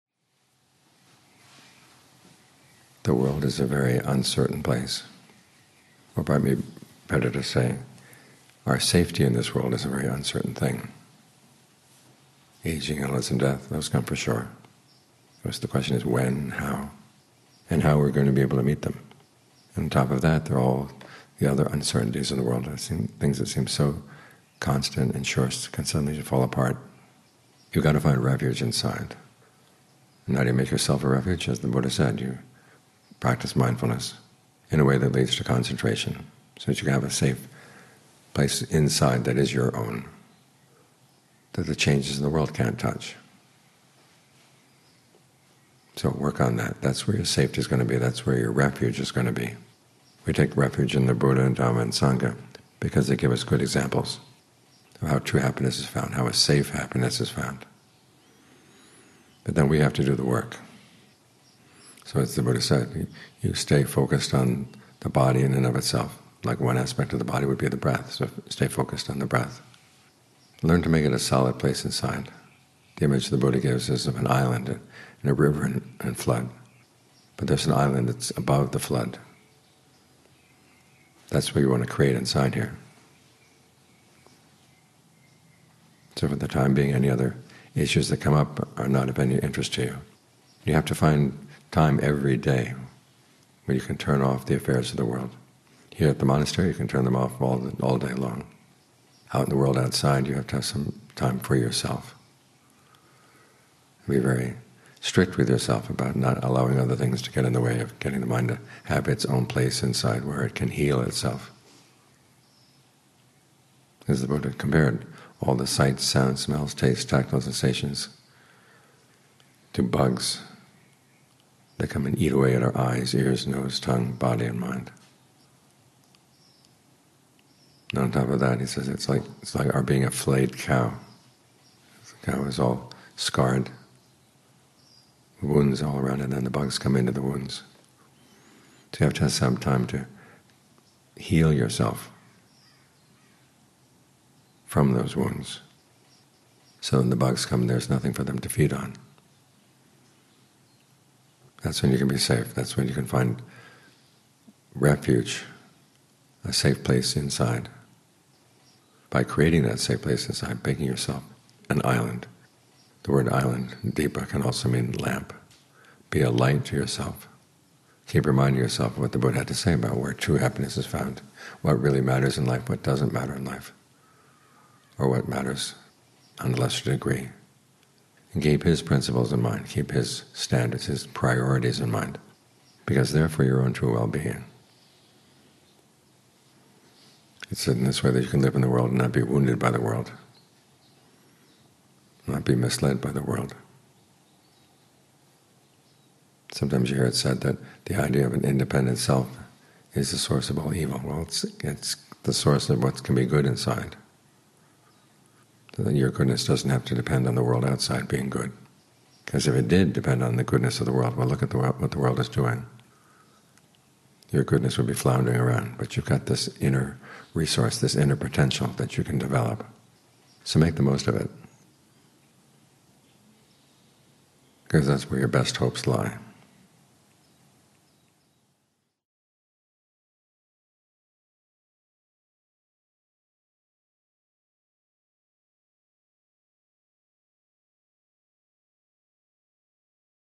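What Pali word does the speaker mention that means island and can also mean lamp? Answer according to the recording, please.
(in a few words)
deepa.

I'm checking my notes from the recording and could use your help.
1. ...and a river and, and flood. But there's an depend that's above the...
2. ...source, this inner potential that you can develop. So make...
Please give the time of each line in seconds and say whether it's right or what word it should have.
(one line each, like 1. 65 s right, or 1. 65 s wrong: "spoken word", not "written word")
1. 74 s wrong: "island", not "depend"
2. 217 s wrong: "resource", not "source".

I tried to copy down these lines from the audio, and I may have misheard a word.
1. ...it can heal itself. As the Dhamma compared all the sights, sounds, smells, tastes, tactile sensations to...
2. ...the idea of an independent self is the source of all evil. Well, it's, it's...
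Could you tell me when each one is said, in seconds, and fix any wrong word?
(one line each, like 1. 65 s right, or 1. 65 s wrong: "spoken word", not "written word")
1. 110 s wrong: "Buddha", not "Dhamma"
2. 197 s right.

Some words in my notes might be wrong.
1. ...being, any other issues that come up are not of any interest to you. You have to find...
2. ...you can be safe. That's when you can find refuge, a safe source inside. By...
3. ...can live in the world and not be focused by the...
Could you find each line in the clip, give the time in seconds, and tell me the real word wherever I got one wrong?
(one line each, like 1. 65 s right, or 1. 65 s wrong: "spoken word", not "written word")
1. 86 s right
2. 151 s wrong: "place", not "source"
3. 188 s wrong: "wounded", not "focused".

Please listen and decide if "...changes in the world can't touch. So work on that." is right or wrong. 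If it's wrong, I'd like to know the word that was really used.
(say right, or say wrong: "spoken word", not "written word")
right.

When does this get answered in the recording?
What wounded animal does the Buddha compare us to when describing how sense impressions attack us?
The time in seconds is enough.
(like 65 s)
130 s.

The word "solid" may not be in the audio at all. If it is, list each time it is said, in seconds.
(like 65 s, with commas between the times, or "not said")
71 s.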